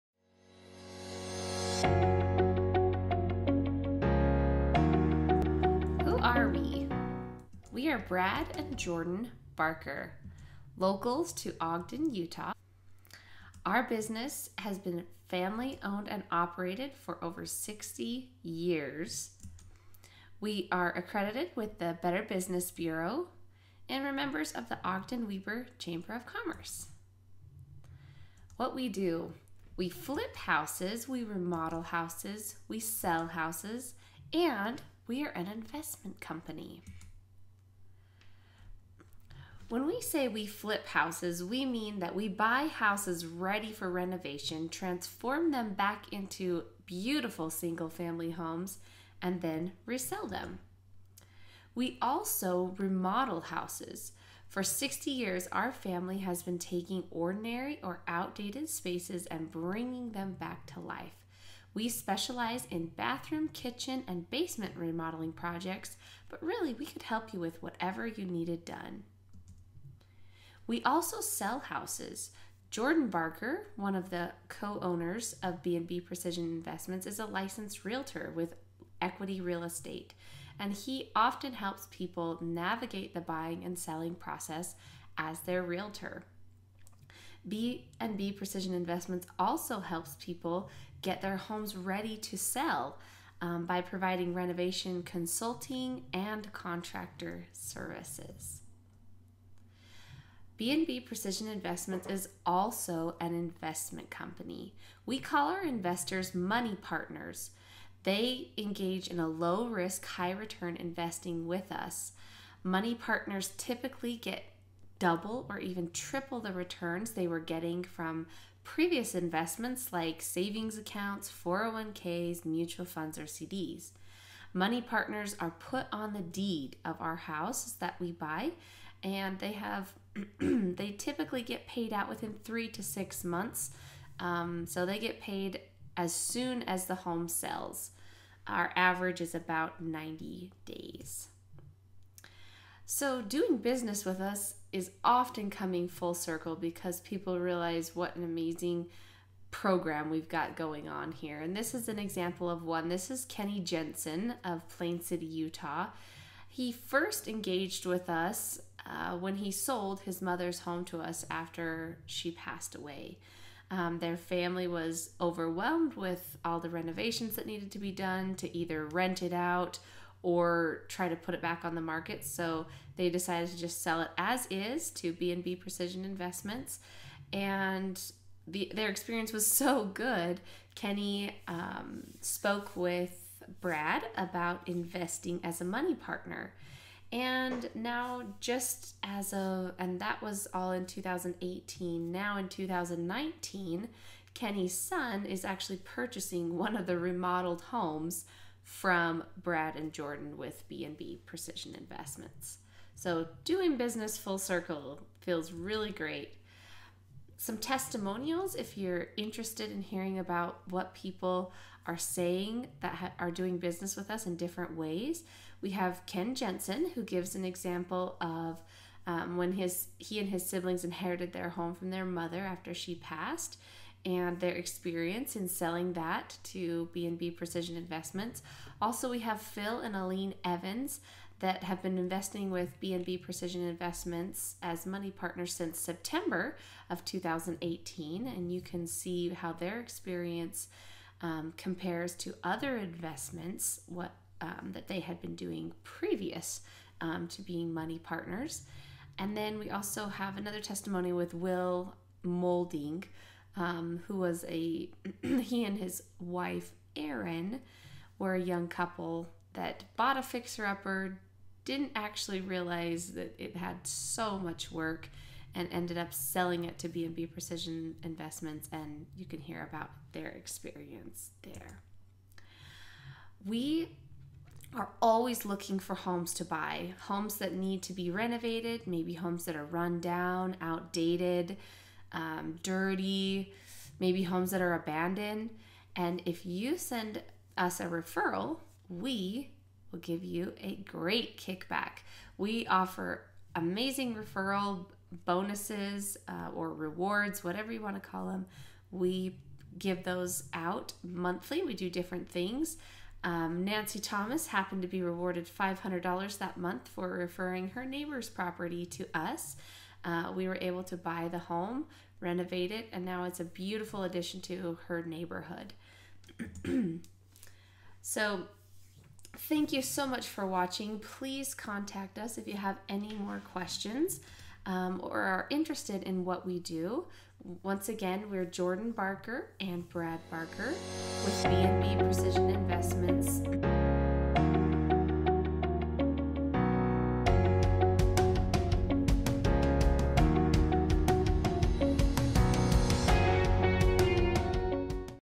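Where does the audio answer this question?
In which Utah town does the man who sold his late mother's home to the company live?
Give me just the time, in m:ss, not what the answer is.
2:34.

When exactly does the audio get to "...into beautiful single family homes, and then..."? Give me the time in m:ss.
0:46.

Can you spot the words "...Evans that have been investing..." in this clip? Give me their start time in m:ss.
3:50.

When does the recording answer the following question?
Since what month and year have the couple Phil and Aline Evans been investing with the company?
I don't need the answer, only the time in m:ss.
3:55.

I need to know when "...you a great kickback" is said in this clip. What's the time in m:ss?
4:50.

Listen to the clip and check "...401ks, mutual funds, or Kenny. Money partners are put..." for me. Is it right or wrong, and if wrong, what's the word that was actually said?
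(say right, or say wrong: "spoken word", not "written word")
wrong: "CDs", not "Kenny".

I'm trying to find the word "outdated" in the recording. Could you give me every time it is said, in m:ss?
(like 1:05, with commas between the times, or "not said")
0:58, 4:40.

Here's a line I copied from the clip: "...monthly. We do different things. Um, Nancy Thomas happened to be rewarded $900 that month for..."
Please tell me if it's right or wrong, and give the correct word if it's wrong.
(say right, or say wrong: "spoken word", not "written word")
wrong: "500", not "900".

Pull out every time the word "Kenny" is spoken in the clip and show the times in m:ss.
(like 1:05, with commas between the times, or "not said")
2:33, 3:00, 3:14.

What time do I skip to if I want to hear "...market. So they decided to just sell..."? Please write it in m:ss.
2:51.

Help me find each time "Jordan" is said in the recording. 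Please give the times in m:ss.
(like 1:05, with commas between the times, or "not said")
0:08, 1:12, 3:19, 5:28.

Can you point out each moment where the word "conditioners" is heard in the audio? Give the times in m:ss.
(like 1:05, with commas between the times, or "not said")
not said.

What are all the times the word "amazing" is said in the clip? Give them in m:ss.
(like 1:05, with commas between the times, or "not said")
2:28, 4:53.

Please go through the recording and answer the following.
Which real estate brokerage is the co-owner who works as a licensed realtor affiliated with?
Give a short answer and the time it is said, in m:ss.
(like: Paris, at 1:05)
Equity Real Estate, at 1:19.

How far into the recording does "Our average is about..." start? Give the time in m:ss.
2:18.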